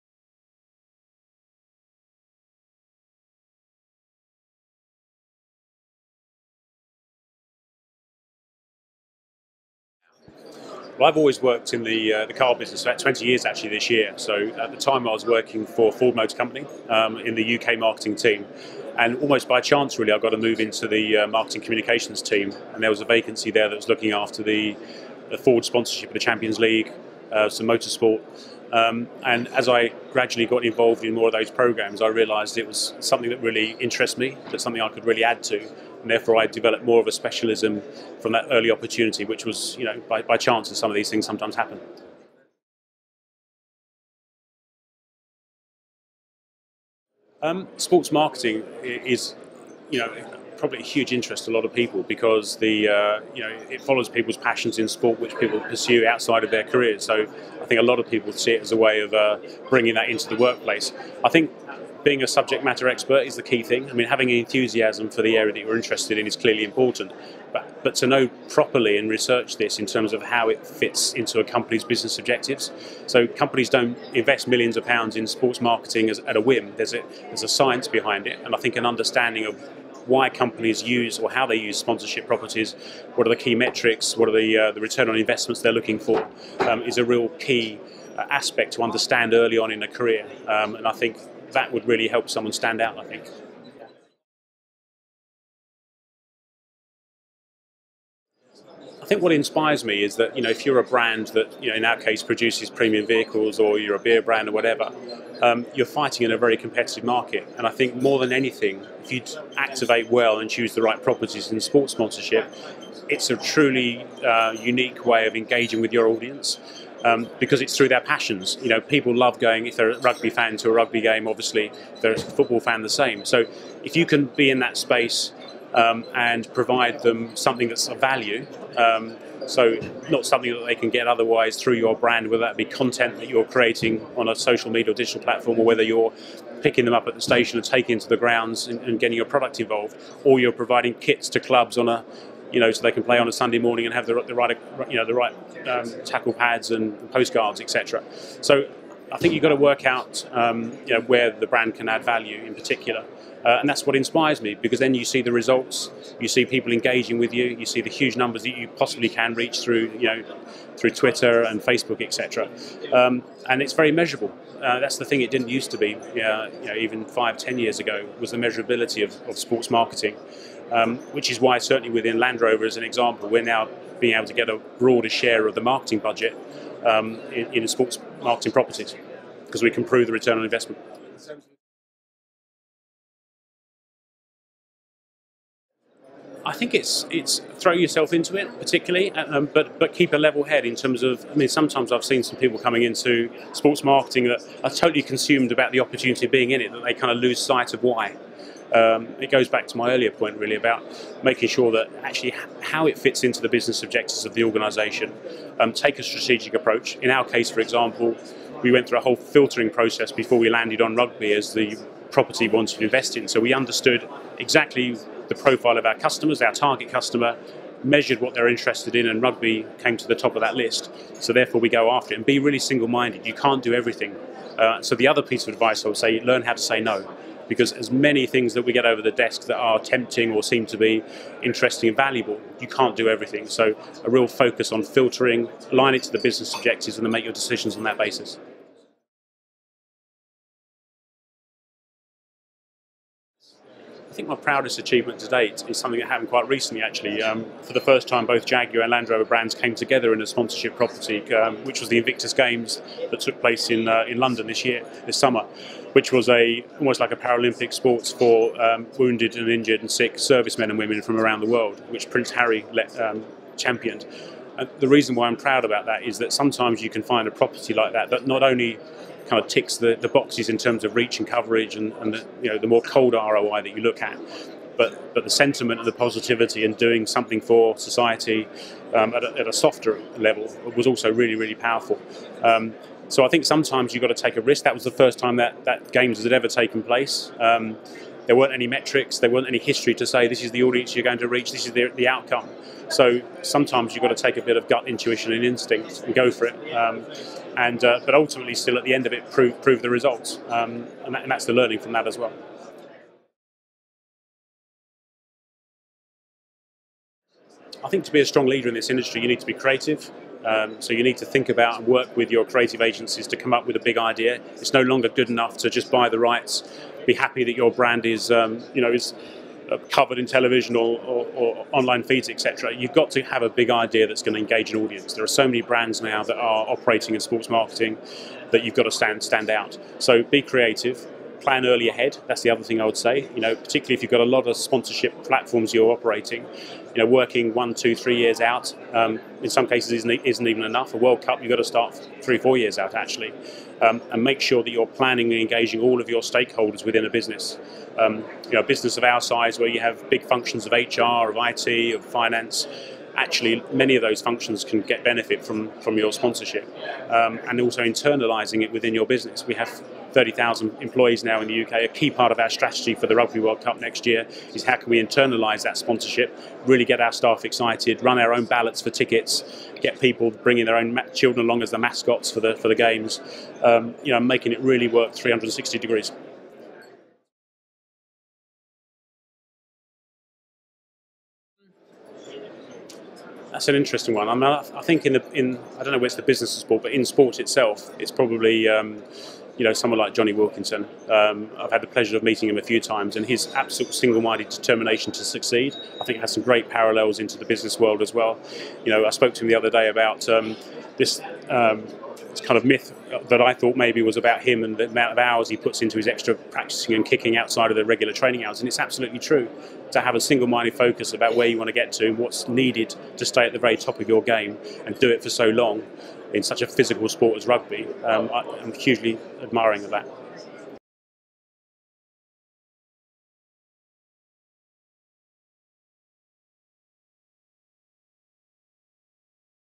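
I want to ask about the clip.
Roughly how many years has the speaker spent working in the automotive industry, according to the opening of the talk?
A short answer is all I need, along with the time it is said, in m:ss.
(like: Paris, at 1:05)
20 years, at 0:12.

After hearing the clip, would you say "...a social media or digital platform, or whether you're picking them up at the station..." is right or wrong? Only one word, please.
right.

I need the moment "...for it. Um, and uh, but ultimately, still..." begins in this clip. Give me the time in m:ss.
4:56.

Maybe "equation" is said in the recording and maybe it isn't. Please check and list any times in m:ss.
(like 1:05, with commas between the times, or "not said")
not said.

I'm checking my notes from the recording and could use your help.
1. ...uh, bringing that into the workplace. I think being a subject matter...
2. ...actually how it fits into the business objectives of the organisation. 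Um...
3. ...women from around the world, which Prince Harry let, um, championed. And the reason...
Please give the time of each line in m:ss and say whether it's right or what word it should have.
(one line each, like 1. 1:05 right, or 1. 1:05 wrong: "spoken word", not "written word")
1. 0:59 right
2. 3:22 right
3. 4:20 right.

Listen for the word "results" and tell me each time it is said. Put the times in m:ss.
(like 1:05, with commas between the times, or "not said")
2:35, 4:59.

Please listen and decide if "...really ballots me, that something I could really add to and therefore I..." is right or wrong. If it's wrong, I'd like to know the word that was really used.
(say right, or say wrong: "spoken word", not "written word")
wrong: "interests", not "ballots".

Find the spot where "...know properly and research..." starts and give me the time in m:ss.
1:08.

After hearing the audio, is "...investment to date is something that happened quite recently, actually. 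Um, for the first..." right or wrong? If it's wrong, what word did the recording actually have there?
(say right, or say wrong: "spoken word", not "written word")
wrong: "achievement", not "investment".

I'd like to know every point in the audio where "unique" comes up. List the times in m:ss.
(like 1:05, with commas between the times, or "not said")
1:54.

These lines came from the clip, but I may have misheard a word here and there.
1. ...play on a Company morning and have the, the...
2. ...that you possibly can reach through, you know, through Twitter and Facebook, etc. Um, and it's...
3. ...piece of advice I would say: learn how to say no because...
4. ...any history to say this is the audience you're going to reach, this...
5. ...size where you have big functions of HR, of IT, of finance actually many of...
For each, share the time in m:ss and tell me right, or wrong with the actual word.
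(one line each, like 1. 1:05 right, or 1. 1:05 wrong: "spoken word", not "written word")
1. 2:23 wrong: "Sunday", not "Company"
2. 2:38 right
3. 3:45 right
4. 4:49 right
5. 5:49 right.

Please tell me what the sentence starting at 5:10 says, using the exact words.
Um, so you need to think about and work with your creative agencies to come up with a big idea.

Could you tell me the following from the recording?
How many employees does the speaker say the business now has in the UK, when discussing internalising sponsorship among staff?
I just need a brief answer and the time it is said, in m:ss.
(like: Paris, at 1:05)
30,000, at 6:00.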